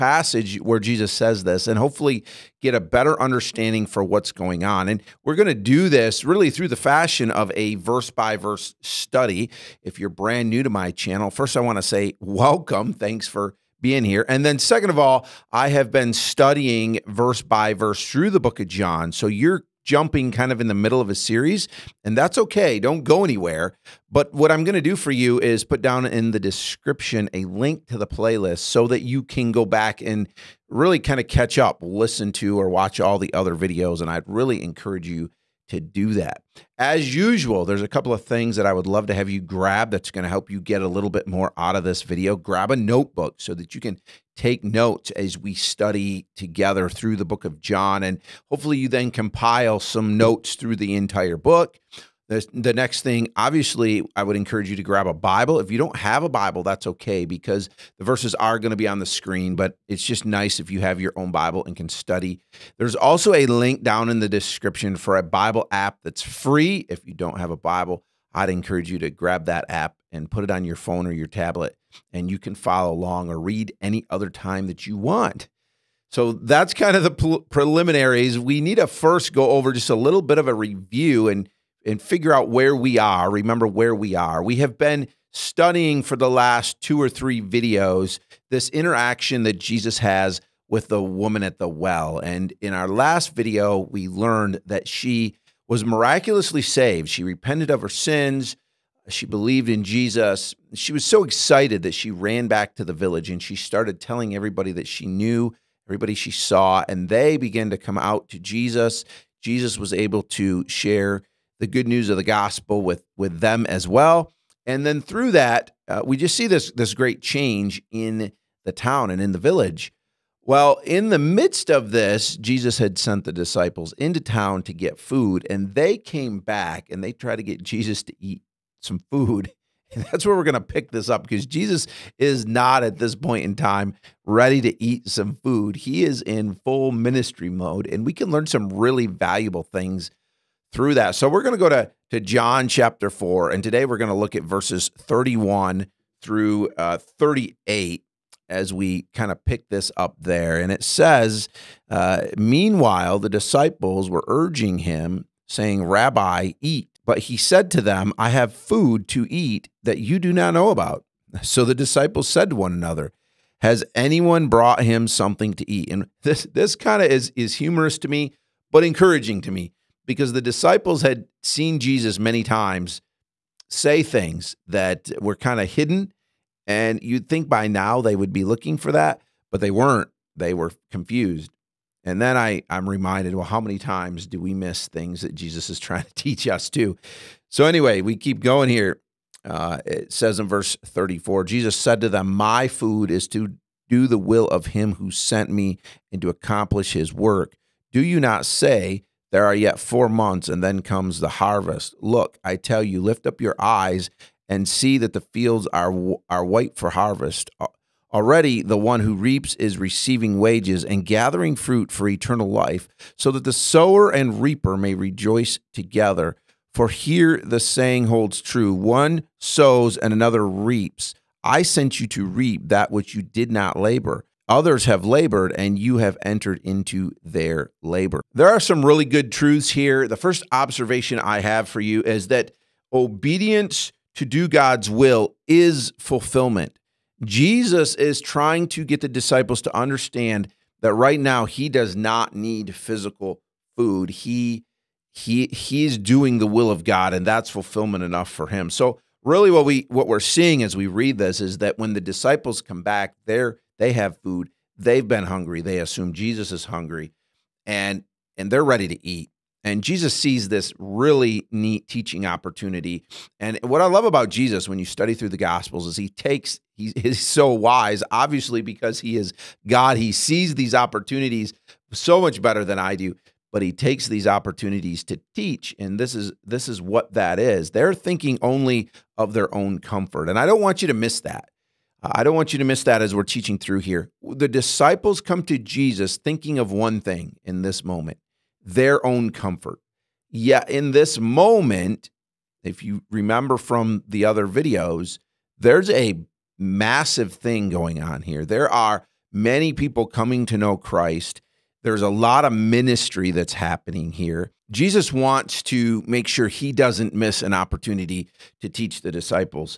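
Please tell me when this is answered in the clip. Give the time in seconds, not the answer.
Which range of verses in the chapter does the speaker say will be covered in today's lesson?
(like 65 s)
144 s.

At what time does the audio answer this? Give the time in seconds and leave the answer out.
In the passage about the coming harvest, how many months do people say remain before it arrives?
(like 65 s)
199 s.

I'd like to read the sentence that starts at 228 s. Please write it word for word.
There are some really good truths here.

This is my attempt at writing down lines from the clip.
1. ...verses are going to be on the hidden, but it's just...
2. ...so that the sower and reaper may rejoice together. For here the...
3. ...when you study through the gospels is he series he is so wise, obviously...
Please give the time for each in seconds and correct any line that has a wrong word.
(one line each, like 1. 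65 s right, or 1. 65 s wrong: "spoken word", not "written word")
1. 58 s wrong: "screen", not "hidden"
2. 213 s right
3. 264 s wrong: "takes", not "series".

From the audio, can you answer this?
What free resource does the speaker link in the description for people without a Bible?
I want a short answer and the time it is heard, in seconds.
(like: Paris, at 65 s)
A Bible app, at 65 s.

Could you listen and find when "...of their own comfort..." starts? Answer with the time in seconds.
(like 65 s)
279 s.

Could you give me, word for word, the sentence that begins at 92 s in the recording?
And in our last video, we learned that she was miraculously saved.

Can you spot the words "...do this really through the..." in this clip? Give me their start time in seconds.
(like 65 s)
5 s.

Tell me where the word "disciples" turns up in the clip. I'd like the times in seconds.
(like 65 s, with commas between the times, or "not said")
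123 s, 153 s, 161 s, 170 s, 239 s, 251 s, 284 s, 309 s.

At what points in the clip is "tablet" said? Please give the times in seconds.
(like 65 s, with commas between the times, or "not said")
71 s.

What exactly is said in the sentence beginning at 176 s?
And you'd think by now they would be looking for that, but they weren't.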